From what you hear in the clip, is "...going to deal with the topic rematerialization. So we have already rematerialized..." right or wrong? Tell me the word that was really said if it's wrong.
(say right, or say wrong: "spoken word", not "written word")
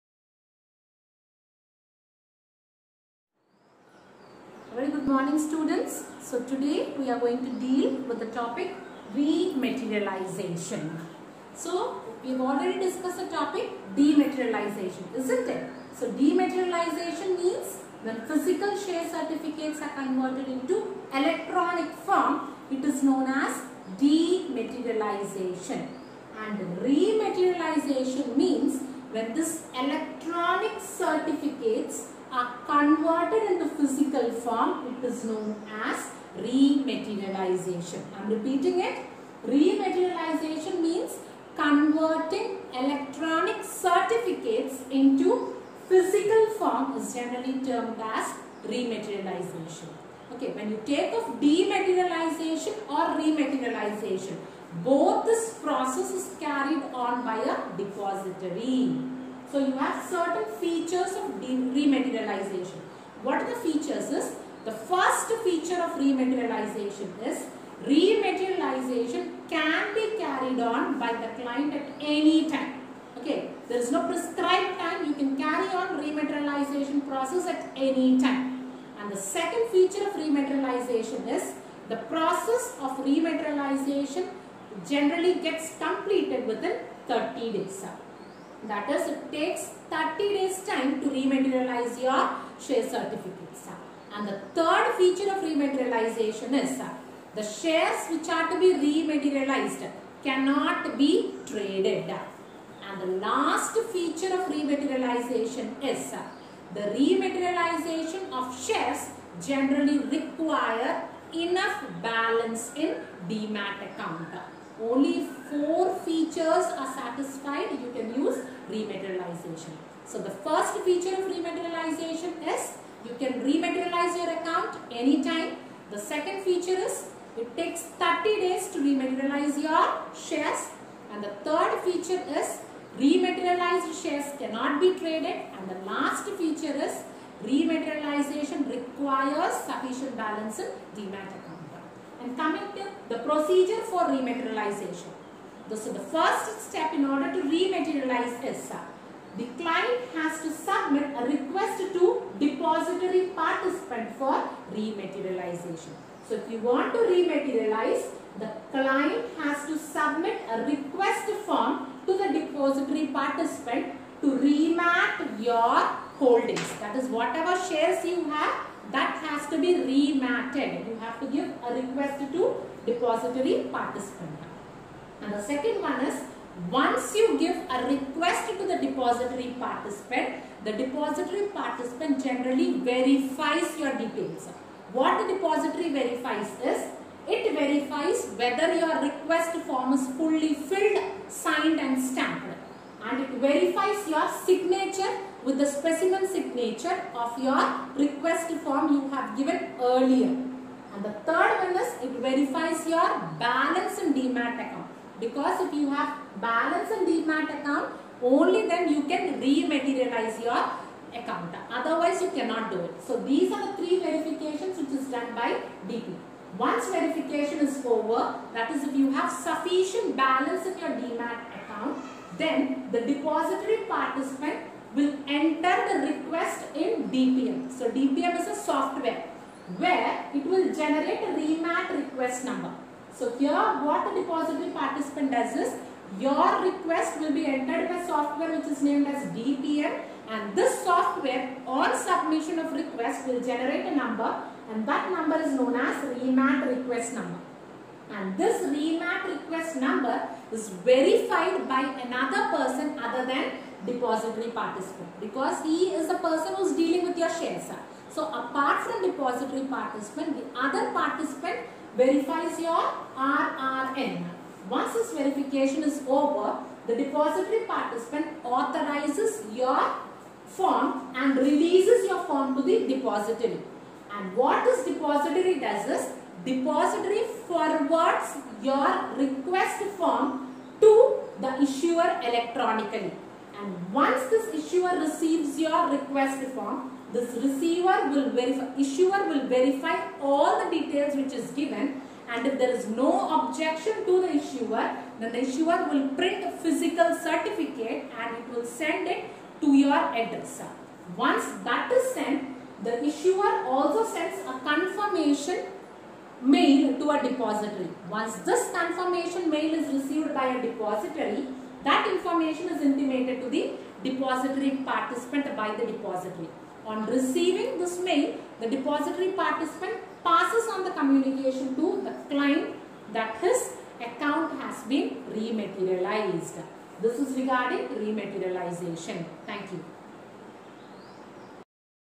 wrong: "discussed", not "rematerialized".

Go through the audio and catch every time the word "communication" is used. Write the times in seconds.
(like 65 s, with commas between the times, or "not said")
320 s.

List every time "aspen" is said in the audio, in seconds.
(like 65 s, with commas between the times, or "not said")
not said.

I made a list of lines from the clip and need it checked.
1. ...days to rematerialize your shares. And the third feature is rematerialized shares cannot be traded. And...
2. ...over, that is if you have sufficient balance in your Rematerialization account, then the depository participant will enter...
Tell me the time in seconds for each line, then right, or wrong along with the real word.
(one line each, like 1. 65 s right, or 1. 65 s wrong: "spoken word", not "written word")
1. 128 s right
2. 217 s wrong: "DMAT", not "Rematerialization".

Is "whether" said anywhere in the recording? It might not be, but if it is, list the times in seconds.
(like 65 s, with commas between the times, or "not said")
188 s.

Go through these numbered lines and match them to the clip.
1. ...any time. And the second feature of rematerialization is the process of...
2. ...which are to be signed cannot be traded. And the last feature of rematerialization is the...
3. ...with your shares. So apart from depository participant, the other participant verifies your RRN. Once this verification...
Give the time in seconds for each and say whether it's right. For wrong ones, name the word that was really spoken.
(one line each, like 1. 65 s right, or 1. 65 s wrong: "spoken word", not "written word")
1. 77 s right
2. 98 s wrong: "rematerialized", not "signed"
3. 257 s right.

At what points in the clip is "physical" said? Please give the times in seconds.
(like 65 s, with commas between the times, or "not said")
18 s, 33 s, 45 s, 296 s.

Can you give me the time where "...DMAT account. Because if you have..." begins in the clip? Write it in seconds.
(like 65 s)
204 s.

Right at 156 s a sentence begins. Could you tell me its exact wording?
So if you want to rematerialize, the client has to submit a request form to the depository participant to remat your holdings.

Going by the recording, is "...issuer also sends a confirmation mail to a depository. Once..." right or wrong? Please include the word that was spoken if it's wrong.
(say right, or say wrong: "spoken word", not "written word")
right.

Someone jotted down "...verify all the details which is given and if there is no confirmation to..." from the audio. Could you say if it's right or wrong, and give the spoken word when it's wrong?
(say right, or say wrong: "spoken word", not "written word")
wrong: "objection", not "confirmation".